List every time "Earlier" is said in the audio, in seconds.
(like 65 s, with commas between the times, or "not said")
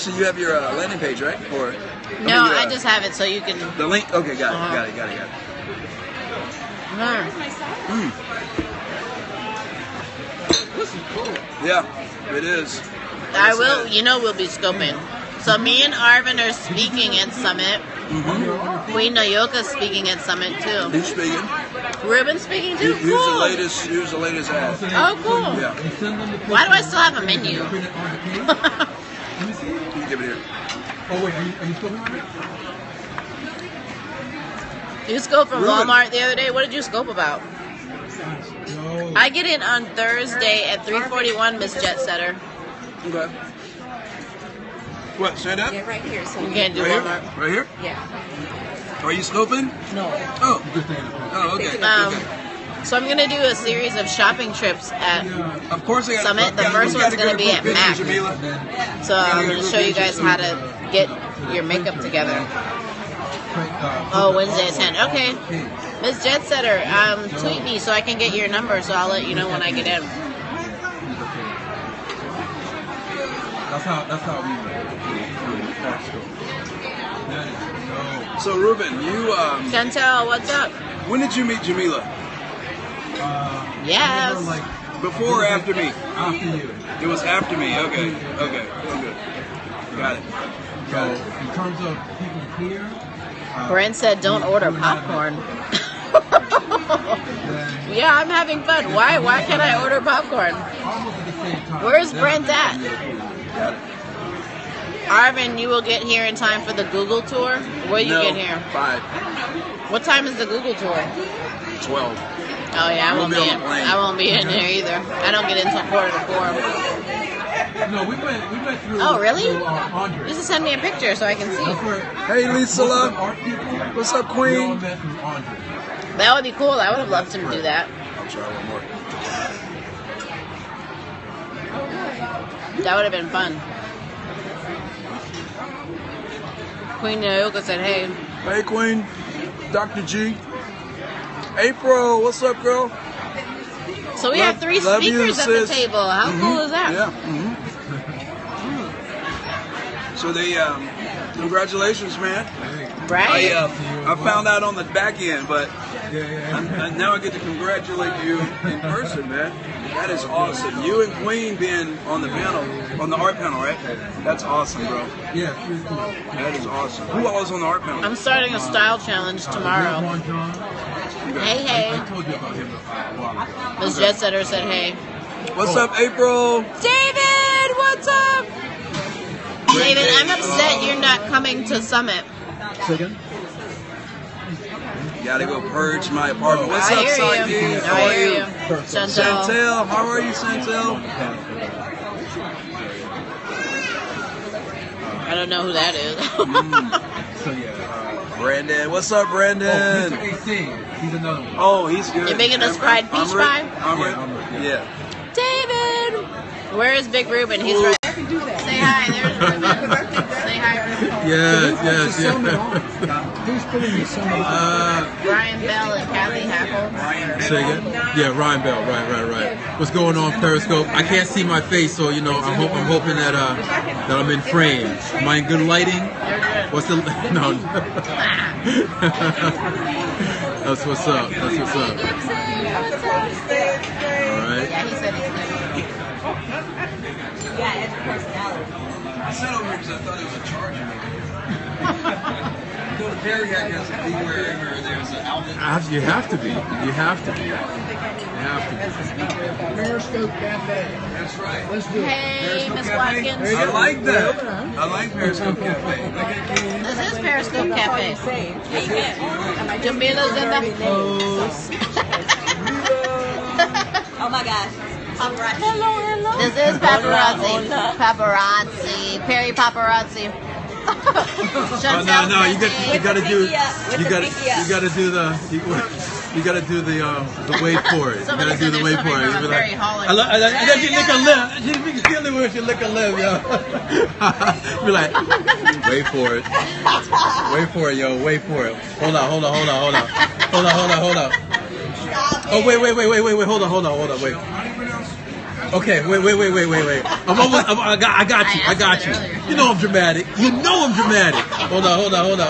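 299 s.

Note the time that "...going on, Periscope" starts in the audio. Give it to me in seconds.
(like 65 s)
219 s.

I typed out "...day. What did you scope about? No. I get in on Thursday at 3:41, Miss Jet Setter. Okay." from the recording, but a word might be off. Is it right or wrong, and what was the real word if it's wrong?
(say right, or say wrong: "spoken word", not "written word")
right.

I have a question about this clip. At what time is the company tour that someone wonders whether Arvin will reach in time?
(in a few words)
12.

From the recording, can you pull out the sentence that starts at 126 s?
I would have loved him to do that.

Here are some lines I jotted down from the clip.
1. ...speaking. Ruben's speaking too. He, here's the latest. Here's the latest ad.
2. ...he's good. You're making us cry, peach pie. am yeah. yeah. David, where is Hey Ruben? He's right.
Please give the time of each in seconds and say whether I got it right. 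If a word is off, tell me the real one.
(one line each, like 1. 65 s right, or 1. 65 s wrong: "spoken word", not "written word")
1. 21 s right
2. 201 s wrong: "Big", not "Hey".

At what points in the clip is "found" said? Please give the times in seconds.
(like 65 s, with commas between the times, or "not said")
154 s.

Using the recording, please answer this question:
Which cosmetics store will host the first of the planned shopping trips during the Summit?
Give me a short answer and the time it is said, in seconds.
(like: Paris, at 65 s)
Mac, at 57 s.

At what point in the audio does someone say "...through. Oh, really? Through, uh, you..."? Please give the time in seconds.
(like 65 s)
118 s.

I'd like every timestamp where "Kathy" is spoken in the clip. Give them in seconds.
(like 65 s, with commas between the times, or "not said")
216 s.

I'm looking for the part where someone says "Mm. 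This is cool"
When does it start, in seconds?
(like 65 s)
10 s.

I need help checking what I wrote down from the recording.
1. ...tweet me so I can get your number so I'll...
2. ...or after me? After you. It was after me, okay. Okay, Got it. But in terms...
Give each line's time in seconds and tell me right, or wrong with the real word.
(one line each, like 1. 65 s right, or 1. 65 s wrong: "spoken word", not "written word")
1. 67 s right
2. 85 s right.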